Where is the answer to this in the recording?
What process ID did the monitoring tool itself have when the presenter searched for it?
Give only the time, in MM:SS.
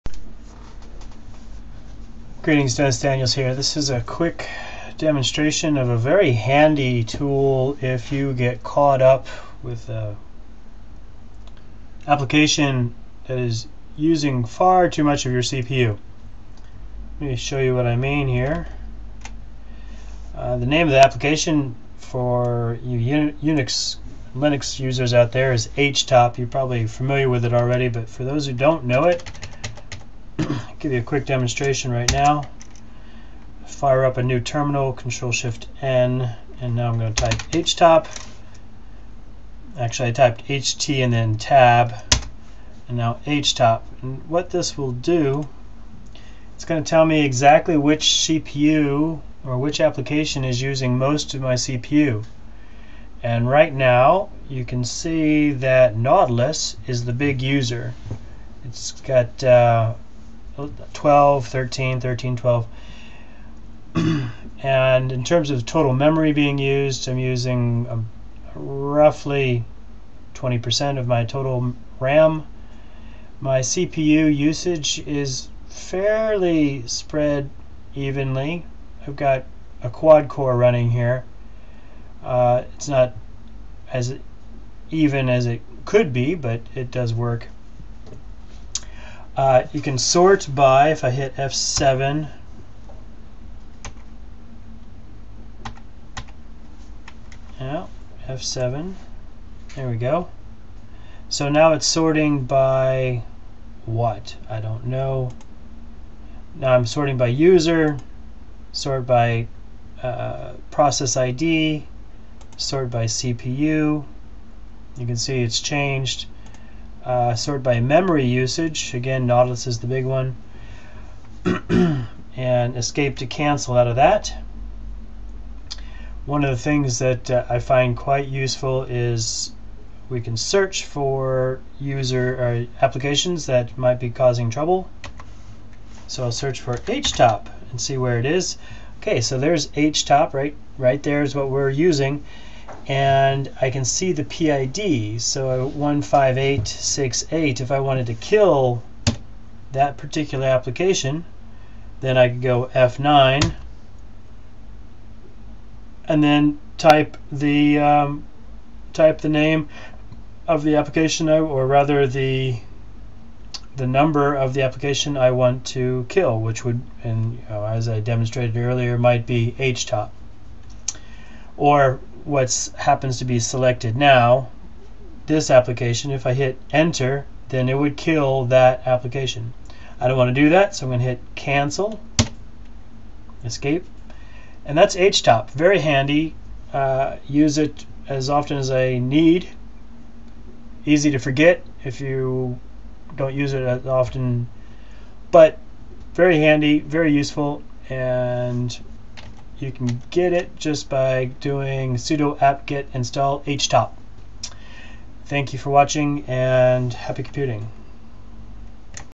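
02:25.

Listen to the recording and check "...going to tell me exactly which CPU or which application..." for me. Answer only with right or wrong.
right.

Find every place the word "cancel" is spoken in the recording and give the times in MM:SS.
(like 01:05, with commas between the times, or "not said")
02:03, 03:01.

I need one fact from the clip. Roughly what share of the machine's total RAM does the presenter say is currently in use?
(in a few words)
20%.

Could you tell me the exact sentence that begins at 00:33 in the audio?
Fire up a new terminal, Control Shift N, and now I'm going to type htop.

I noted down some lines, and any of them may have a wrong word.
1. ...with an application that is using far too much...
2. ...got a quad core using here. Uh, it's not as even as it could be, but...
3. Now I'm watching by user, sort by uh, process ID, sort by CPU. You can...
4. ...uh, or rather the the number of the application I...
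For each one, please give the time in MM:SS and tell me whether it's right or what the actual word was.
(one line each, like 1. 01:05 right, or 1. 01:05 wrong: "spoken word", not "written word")
1. 00:09 right
2. 01:19 wrong: "running", not "using"
3. 01:46 wrong: "sorting", not "watching"
4. 02:41 right.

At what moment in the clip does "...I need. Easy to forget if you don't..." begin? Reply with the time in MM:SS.
03:08.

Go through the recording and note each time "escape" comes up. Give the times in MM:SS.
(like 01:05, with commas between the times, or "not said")
02:02, 03:03.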